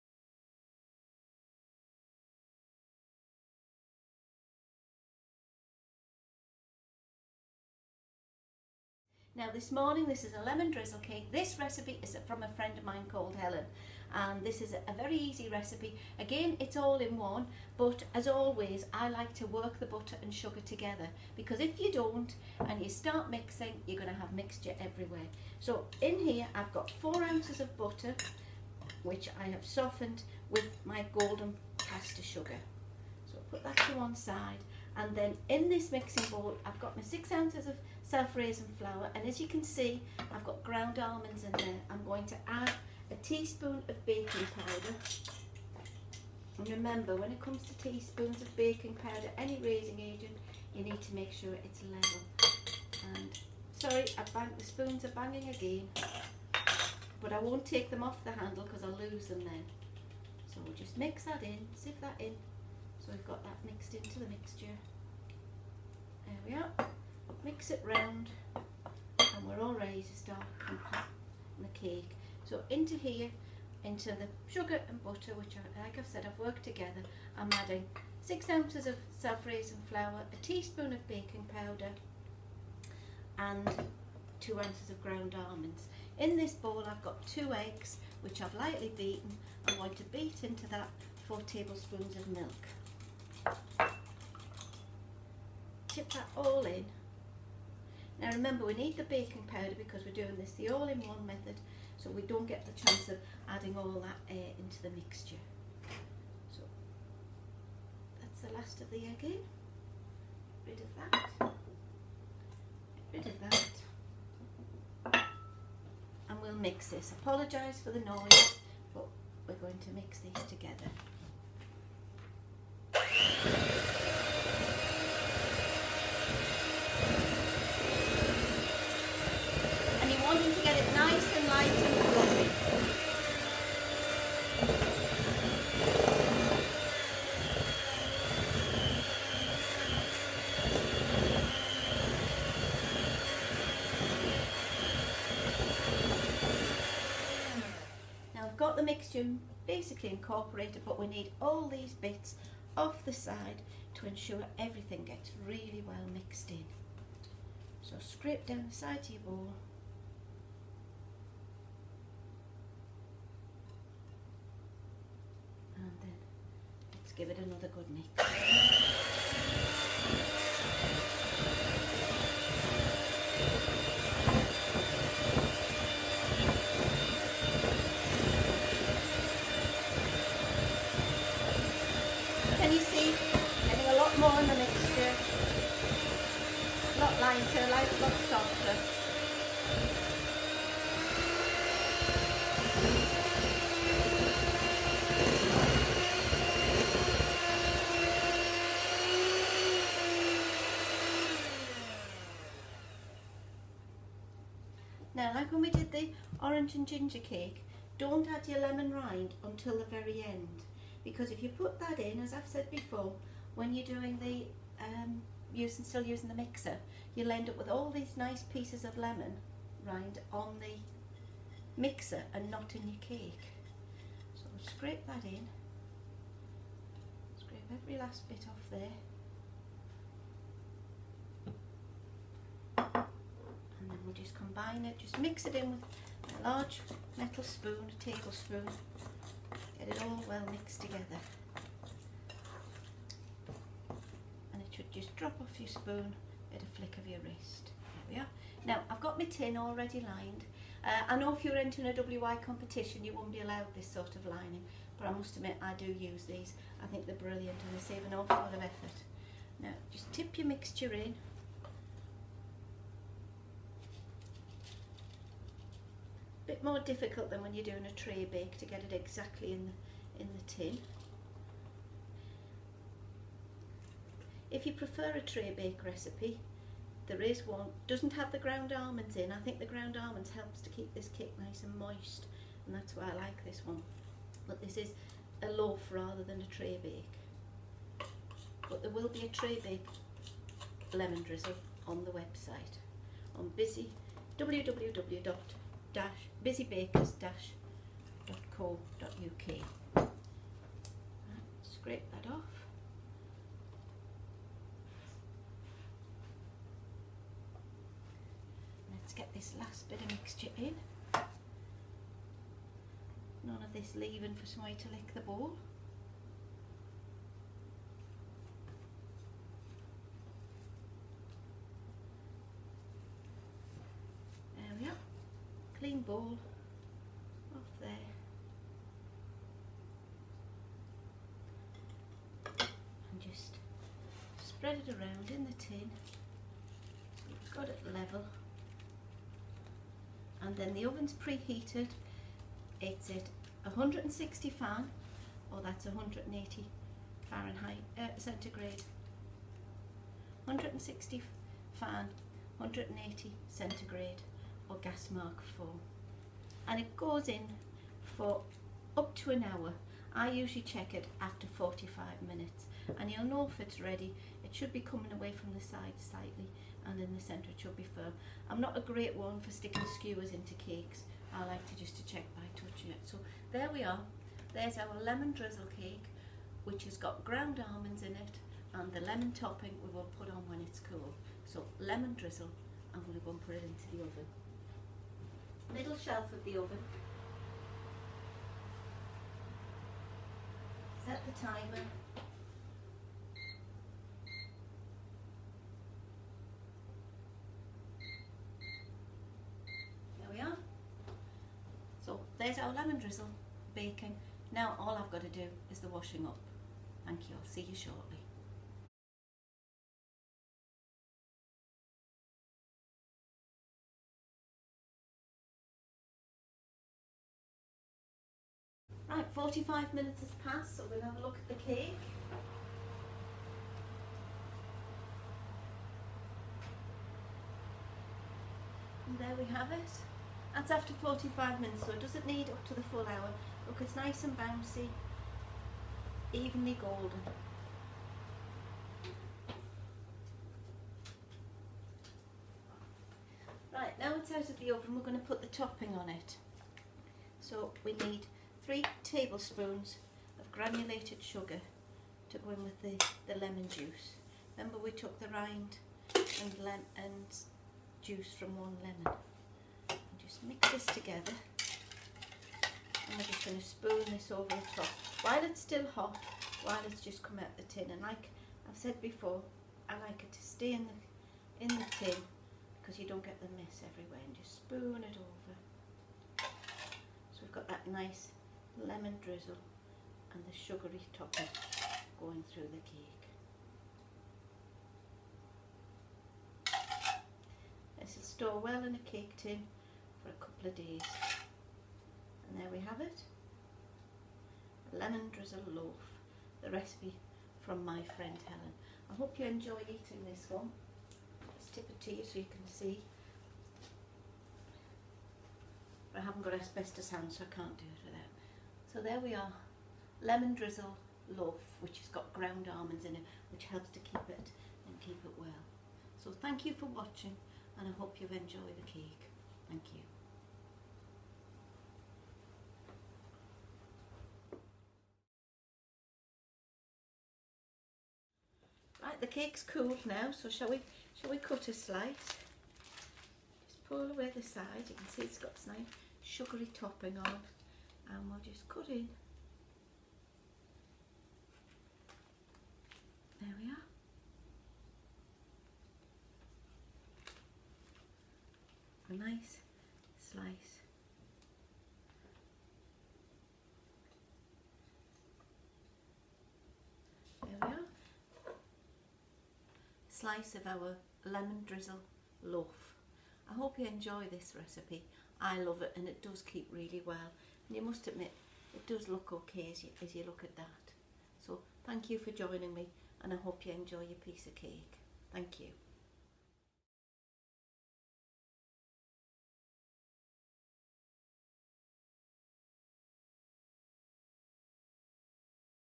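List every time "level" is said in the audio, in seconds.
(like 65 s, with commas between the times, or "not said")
51 s, 337 s.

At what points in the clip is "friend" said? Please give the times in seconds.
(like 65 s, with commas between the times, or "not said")
12 s, 498 s.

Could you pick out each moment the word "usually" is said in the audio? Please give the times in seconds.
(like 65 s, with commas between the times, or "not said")
360 s.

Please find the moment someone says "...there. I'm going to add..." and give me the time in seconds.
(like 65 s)
41 s.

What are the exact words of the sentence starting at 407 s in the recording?
Thank you, I'll see you shortly.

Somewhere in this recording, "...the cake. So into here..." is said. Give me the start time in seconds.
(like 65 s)
70 s.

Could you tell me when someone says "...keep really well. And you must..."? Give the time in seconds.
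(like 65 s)
566 s.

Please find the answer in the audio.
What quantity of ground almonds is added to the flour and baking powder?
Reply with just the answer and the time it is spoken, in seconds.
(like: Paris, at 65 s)
2 ounces, at 84 s.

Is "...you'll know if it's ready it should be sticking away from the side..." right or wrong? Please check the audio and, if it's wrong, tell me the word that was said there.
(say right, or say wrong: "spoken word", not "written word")
wrong: "coming", not "sticking".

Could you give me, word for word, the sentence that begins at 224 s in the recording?
So I'll scrape that in, scrape every last bit off there.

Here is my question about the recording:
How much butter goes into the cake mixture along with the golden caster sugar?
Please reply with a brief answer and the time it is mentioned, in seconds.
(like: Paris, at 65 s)
4 ounces, at 26 s.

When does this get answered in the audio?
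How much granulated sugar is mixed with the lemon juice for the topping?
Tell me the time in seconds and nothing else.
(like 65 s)
448 s.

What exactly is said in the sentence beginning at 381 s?
So lemon drizzle, I'm going to go and put it into the oven.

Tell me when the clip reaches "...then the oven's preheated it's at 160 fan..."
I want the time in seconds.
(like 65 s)
340 s.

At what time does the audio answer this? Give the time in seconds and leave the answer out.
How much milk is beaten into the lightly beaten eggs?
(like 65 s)
91 s.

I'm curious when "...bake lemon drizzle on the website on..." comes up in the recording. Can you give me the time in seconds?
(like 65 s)
289 s.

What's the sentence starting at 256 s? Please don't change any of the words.
I think they're brilliant and they save an awful lot of effort.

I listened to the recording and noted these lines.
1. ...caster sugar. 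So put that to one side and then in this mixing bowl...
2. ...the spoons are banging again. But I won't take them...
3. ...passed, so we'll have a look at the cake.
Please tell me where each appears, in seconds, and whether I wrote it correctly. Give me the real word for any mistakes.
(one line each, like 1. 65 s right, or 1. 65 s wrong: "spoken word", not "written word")
1. 31 s right
2. 54 s right
3. 420 s right.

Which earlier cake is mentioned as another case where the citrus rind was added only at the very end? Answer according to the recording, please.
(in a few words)
orange and ginger cake.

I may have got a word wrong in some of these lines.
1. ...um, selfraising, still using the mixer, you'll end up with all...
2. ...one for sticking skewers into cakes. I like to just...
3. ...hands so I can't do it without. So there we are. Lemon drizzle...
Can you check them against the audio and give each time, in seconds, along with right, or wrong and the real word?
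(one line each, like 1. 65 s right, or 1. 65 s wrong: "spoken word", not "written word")
1. 214 s wrong: "using", not "selfraising"
2. 369 s right
3. 507 s right.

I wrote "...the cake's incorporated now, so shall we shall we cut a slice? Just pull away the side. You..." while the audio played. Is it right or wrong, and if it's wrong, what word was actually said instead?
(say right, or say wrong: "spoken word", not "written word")
wrong: "cooled", not "incorporated".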